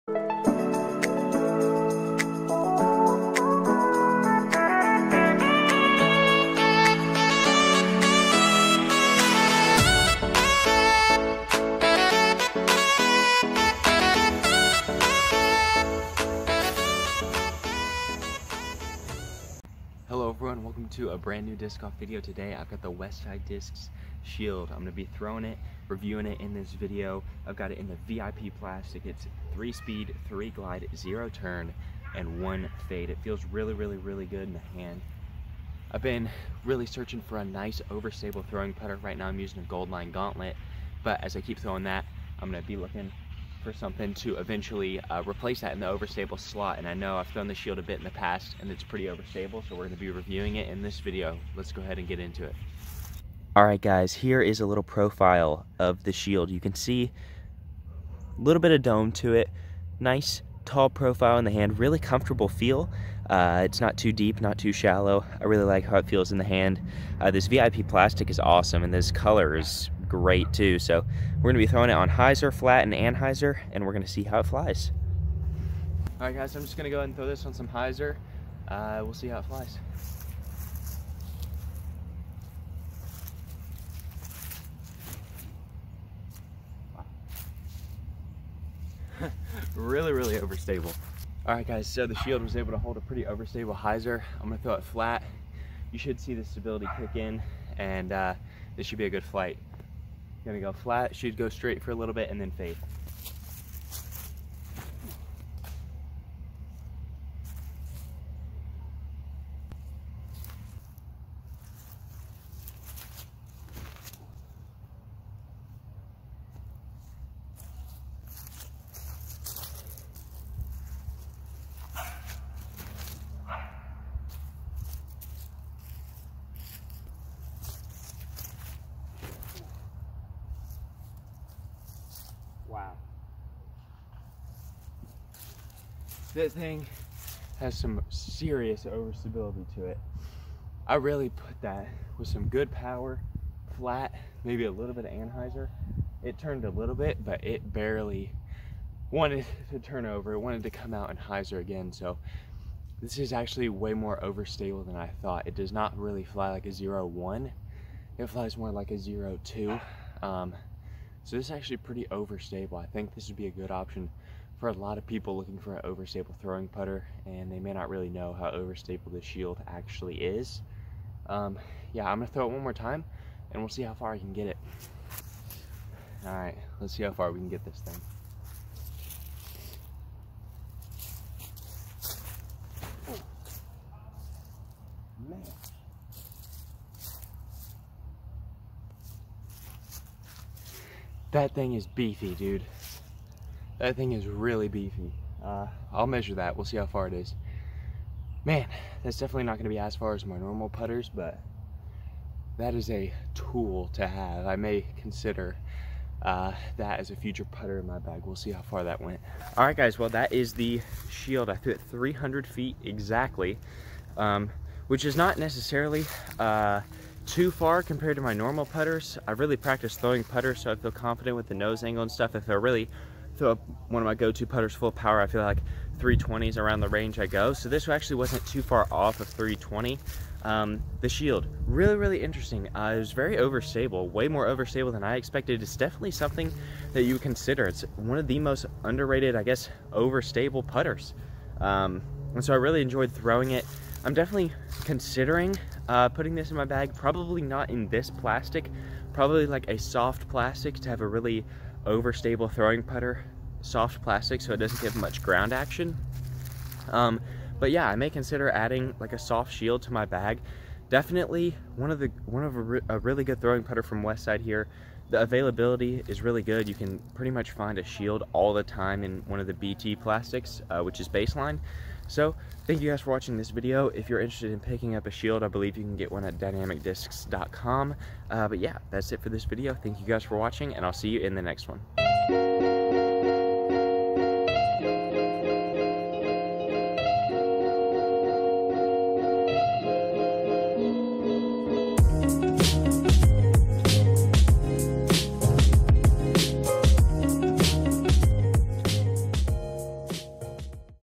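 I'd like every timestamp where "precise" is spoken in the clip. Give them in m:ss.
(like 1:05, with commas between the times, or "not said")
not said.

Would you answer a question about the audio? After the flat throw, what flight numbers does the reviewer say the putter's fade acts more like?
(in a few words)
0 2.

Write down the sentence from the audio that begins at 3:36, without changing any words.
Uh, too far compared to my normal putters.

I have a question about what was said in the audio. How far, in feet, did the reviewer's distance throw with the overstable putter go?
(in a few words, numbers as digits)
300 feet.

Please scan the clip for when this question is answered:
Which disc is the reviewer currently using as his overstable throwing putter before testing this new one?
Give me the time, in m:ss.
0:39.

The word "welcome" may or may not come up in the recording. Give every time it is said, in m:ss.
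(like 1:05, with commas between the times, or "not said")
0:20.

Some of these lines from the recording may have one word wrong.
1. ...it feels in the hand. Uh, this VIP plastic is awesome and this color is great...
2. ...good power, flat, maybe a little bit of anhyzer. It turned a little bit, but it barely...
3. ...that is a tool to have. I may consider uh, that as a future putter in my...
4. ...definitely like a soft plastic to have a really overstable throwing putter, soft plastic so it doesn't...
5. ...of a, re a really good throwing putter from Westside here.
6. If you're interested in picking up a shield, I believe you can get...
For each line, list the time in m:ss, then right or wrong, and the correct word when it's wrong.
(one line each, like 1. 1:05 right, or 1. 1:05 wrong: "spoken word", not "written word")
1. 1:05 right
2. 2:22 right
3. 3:22 right
4. 4:09 wrong: "probably", not "definitely"
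5. 4:22 right
6. 4:33 right.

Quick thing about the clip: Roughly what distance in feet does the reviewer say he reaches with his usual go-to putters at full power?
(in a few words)
320.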